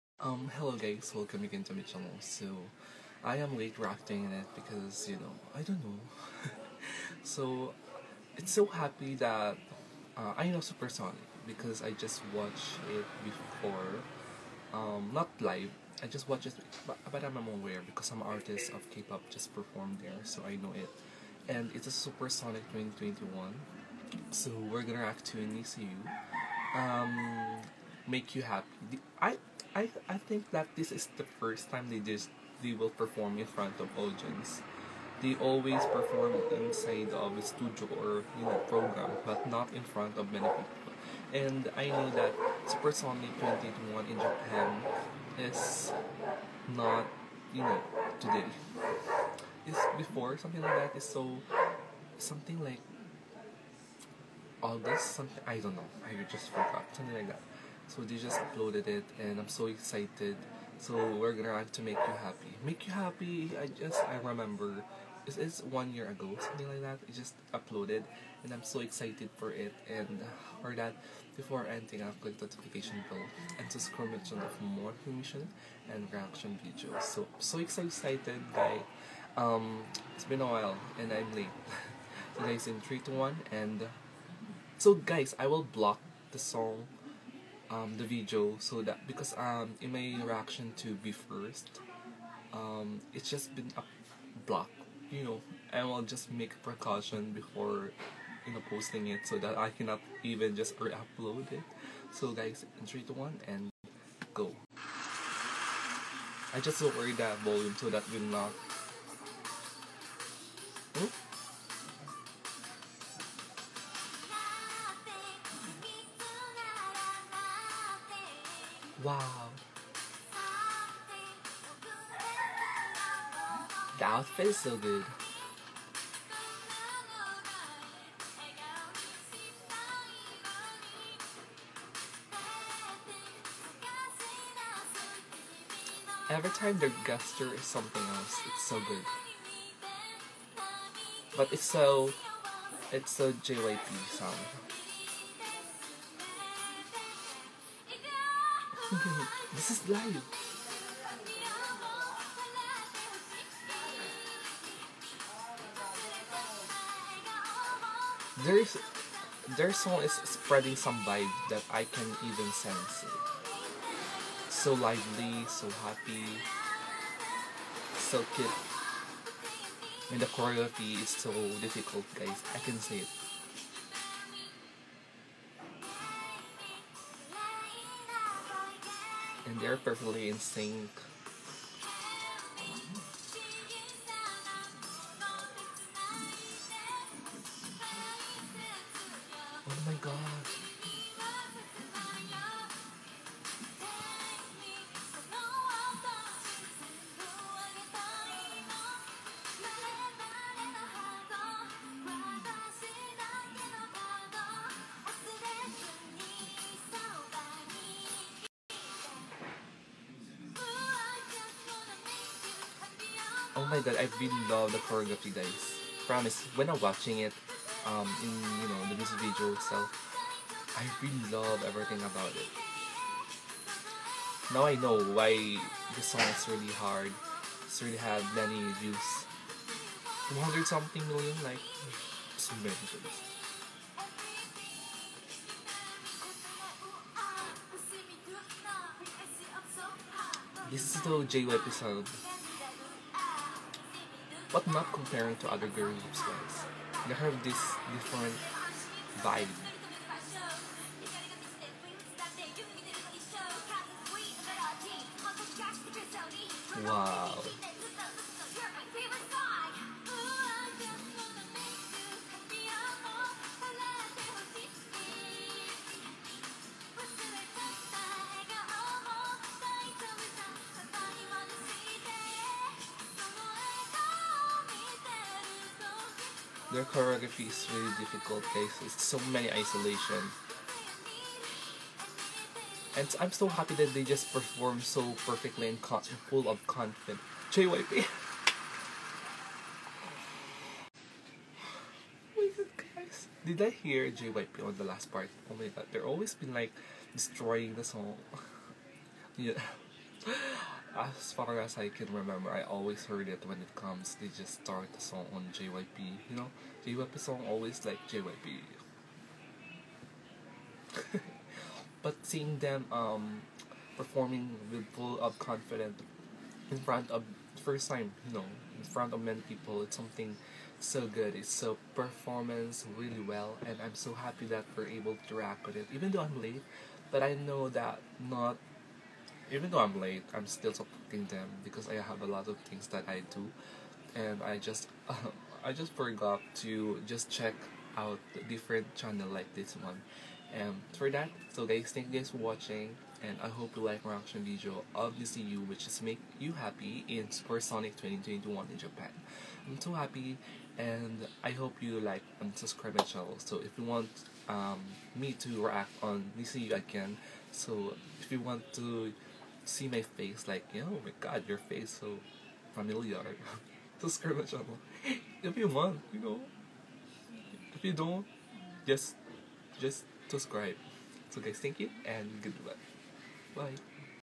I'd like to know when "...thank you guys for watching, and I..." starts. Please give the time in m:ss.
5:41.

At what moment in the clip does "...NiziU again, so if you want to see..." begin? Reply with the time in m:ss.
5:56.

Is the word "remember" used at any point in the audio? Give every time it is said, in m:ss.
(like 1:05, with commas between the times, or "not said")
1:04, 5:02.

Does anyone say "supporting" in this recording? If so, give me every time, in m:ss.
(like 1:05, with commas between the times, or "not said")
5:30.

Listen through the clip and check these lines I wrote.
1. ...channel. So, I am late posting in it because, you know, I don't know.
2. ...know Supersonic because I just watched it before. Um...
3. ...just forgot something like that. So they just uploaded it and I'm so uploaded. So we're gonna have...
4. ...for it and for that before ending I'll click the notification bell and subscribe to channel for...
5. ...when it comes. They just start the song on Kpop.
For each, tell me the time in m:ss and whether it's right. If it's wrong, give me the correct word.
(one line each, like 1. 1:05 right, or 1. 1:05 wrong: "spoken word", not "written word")
1. 0:01 wrong: "reacting", not "posting"
2. 0:10 right
3. 0:56 wrong: "excited", not "uploaded"
4. 1:09 right
5. 5:03 wrong: "JYP", not "Kpop".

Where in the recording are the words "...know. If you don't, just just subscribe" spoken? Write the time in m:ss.
6:06.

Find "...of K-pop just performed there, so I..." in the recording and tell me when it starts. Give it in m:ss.
0:18.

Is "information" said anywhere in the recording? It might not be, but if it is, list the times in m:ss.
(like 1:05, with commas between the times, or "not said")
1:14.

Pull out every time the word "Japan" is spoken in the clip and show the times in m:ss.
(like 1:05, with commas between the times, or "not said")
0:44, 5:48.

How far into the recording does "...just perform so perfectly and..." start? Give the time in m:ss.
4:44.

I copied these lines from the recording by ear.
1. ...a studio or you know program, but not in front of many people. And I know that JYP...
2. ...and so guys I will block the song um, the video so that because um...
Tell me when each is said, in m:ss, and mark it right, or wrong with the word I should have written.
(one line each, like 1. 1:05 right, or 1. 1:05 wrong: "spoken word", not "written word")
1. 0:37 wrong: "Supersonic", not "JYP"
2. 1:23 right.